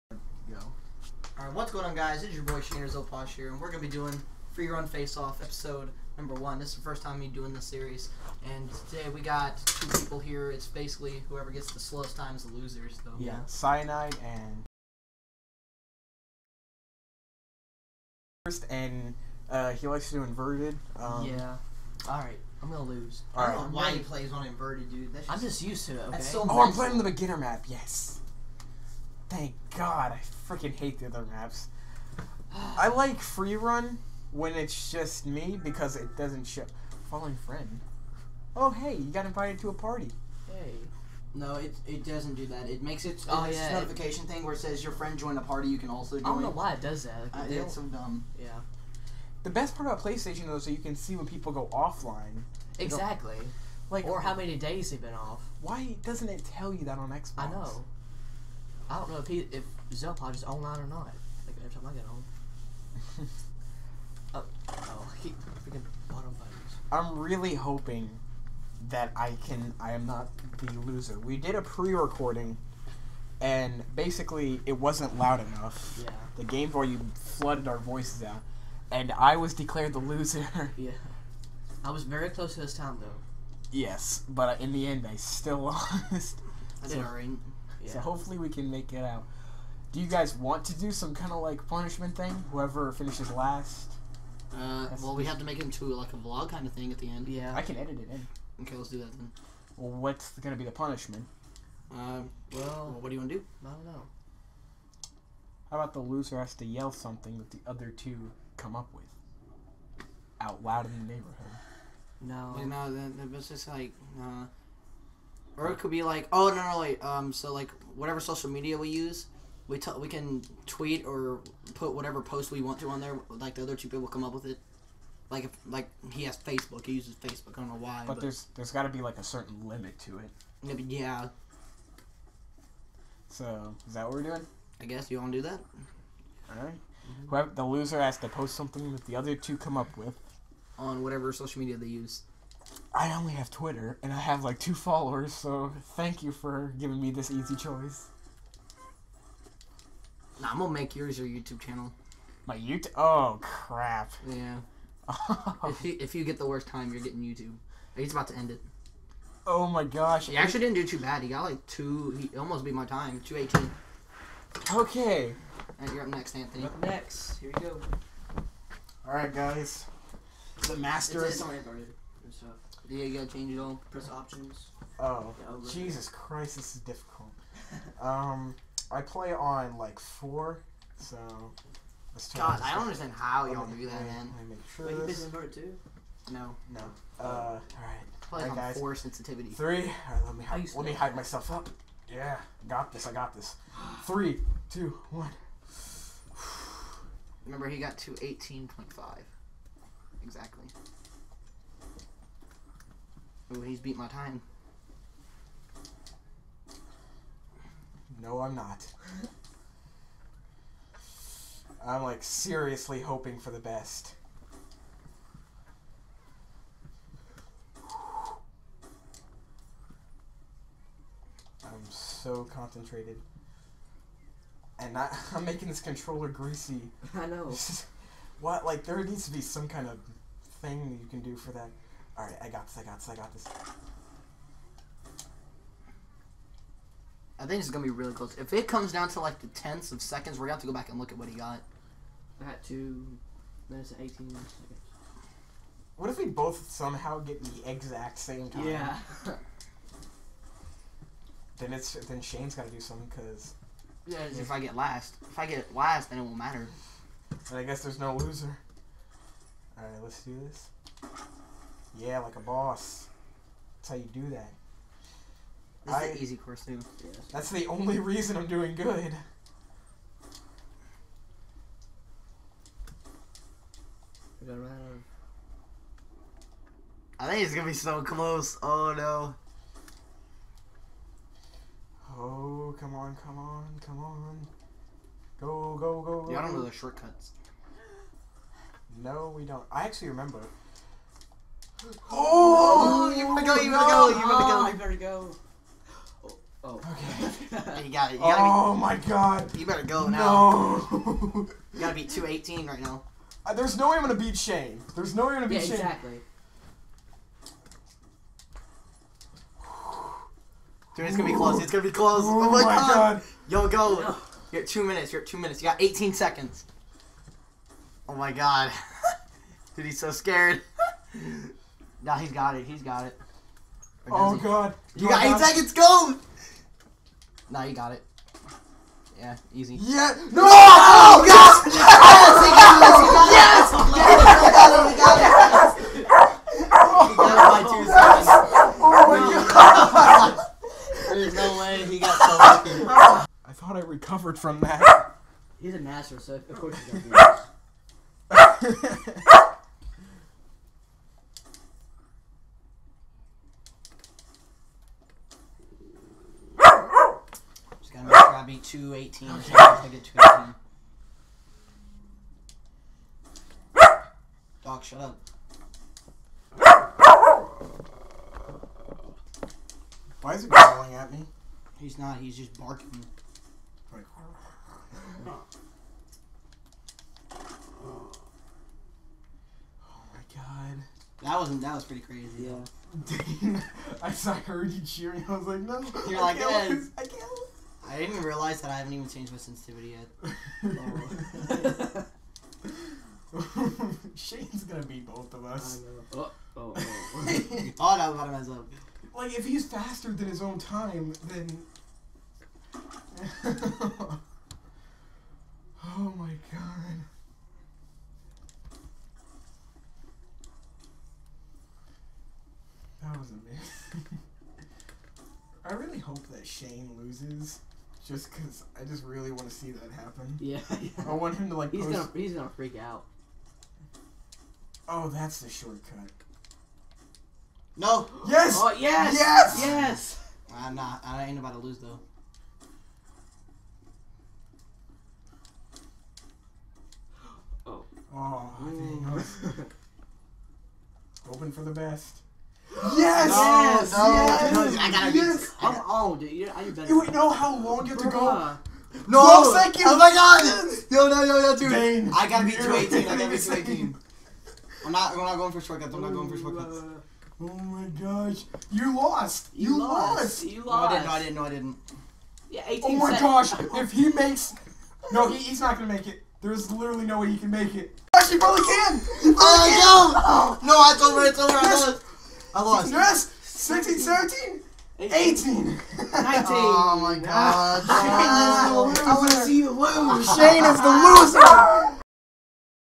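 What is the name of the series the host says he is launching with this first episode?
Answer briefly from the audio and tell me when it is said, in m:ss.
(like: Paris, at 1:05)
Free Run Face Off, at 0:04.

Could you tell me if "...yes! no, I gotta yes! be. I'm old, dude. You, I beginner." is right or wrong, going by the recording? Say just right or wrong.
wrong.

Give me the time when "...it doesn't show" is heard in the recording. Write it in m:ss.
0:35.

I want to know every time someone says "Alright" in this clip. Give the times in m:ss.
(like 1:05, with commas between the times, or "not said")
0:01, 0:22, 3:52.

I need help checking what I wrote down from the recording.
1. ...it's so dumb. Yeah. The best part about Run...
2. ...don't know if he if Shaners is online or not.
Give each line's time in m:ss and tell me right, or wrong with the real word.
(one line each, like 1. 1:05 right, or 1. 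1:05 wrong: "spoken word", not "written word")
1. 0:47 wrong: "PlayStation", not "Run"
2. 0:58 wrong: "Zelpod", not "Shaners".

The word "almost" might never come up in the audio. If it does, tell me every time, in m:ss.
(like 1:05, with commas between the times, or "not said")
2:42.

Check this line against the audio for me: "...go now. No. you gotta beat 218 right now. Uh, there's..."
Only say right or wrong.
right.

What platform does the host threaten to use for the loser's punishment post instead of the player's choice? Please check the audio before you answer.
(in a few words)
YouTube channel.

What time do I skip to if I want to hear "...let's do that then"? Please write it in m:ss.
1:38.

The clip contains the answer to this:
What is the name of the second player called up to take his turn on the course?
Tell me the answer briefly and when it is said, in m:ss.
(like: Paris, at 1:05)
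Anthony, at 2:46.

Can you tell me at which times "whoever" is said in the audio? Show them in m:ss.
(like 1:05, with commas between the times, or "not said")
0:11, 1:32, 2:17.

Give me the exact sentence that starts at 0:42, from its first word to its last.
It makes it oh, uh, yeah.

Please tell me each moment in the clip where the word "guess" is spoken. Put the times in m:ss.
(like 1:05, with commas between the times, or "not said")
2:14, 4:17.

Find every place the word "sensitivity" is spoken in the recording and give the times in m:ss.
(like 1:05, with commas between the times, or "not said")
3:08, 6:29.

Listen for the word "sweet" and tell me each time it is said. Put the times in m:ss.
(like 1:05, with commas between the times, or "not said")
not said.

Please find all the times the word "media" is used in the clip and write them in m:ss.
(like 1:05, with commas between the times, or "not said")
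1:58, 2:21.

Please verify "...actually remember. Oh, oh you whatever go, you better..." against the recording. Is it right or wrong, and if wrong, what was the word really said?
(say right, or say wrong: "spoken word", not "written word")
wrong: "better", not "whatever".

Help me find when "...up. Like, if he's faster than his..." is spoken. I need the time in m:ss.
6:38.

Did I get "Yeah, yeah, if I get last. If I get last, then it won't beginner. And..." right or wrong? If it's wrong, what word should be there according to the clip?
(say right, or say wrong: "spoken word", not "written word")
wrong: "matter", not "beginner".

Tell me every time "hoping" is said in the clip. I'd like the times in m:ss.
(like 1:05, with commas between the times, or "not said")
1:07, 3:33.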